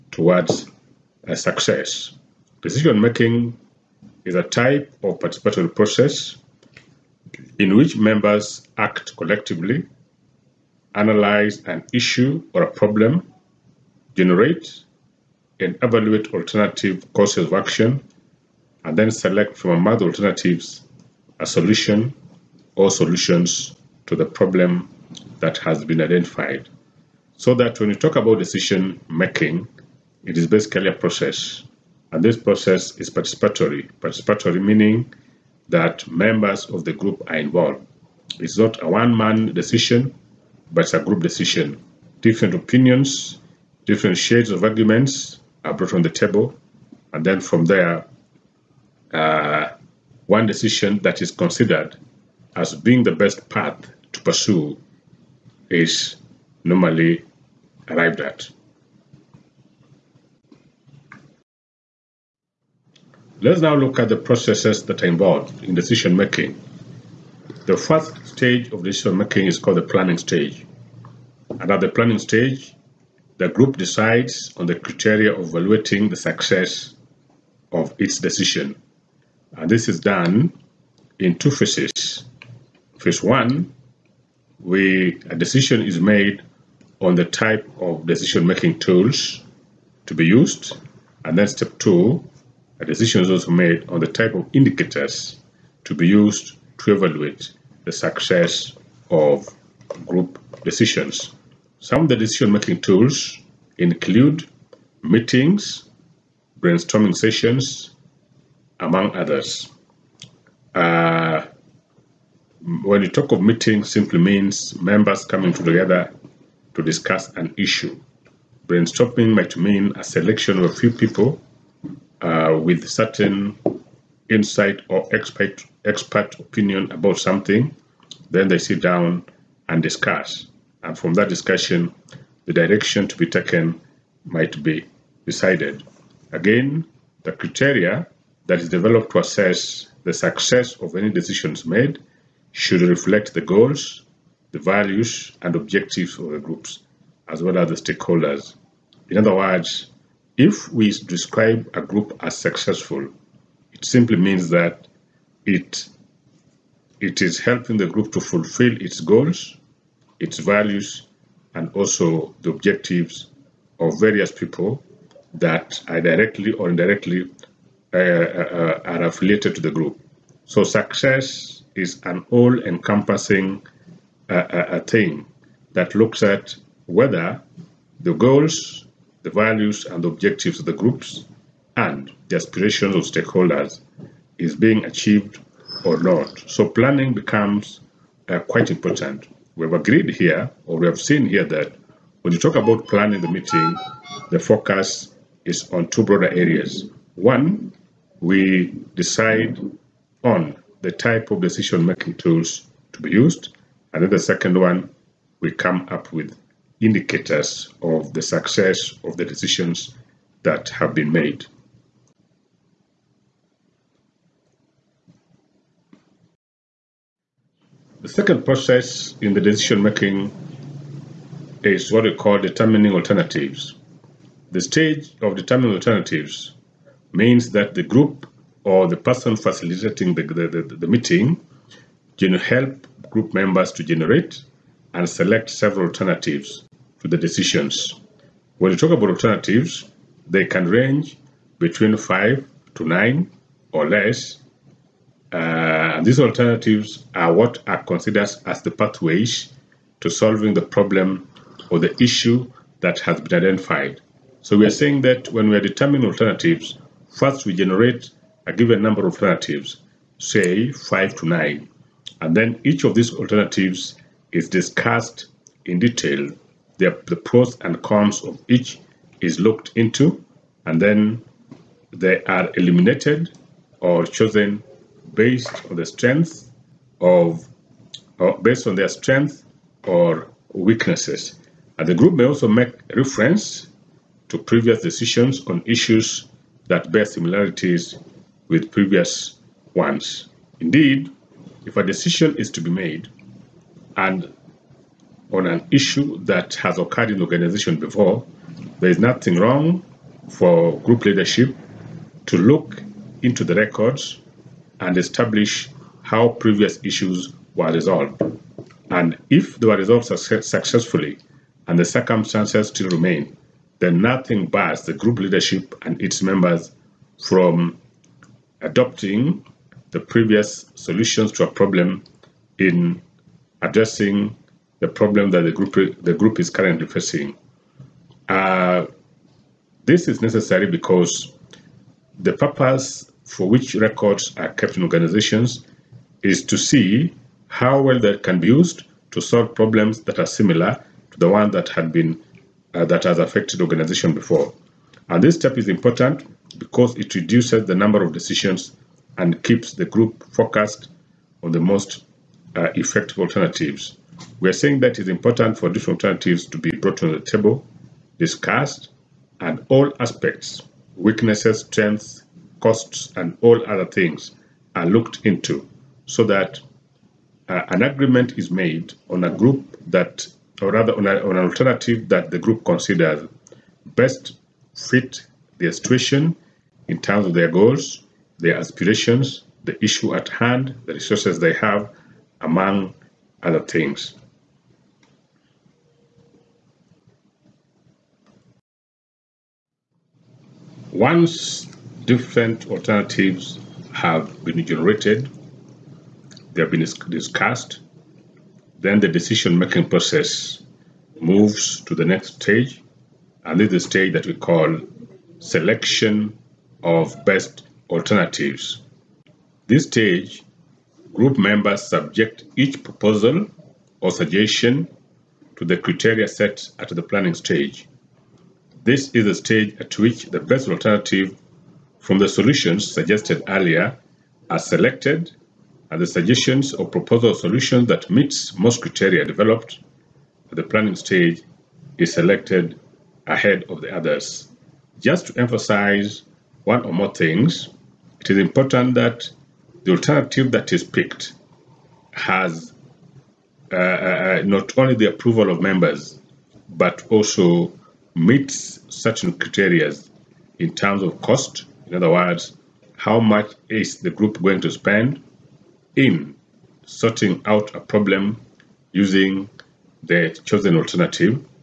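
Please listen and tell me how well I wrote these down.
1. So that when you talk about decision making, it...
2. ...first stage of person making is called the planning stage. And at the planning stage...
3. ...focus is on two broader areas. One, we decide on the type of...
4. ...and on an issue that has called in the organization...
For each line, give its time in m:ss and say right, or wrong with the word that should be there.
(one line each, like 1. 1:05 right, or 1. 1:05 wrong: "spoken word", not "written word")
1. 0:27 right
2. 1:07 wrong: "decision", not "person"
3. 3:14 right
4. 4:53 wrong: "occurred", not "called".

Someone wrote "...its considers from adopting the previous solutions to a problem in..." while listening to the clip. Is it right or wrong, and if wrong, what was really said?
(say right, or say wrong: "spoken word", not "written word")
wrong: "members", not "considers".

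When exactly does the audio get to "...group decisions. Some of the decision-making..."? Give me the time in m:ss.
1:40.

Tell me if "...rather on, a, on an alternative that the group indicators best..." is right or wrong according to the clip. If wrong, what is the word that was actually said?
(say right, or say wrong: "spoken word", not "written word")
wrong: "considers", not "indicators".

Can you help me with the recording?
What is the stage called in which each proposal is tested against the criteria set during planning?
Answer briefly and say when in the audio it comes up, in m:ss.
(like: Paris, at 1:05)
selection of best alternatives, at 6:45.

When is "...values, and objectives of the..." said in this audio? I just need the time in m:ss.
2:24.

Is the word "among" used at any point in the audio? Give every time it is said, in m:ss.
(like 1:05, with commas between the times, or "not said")
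0:19, 1:48, 6:22.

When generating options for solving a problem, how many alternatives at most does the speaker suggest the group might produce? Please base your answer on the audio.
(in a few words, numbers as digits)
9.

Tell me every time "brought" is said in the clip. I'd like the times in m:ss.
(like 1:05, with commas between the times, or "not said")
0:45, 5:56.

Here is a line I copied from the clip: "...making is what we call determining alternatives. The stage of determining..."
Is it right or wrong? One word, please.
right.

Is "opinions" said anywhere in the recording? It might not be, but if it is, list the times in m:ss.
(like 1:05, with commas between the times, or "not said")
0:42, 2:06.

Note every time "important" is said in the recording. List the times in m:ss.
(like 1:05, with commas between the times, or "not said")
3:08, 5:45, 5:55, 7:18.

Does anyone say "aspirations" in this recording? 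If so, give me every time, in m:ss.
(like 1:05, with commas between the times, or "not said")
3:02, 6:18.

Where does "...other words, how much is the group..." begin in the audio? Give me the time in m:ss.
7:31.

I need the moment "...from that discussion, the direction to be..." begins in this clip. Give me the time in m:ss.
2:10.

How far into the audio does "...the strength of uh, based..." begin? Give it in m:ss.
4:35.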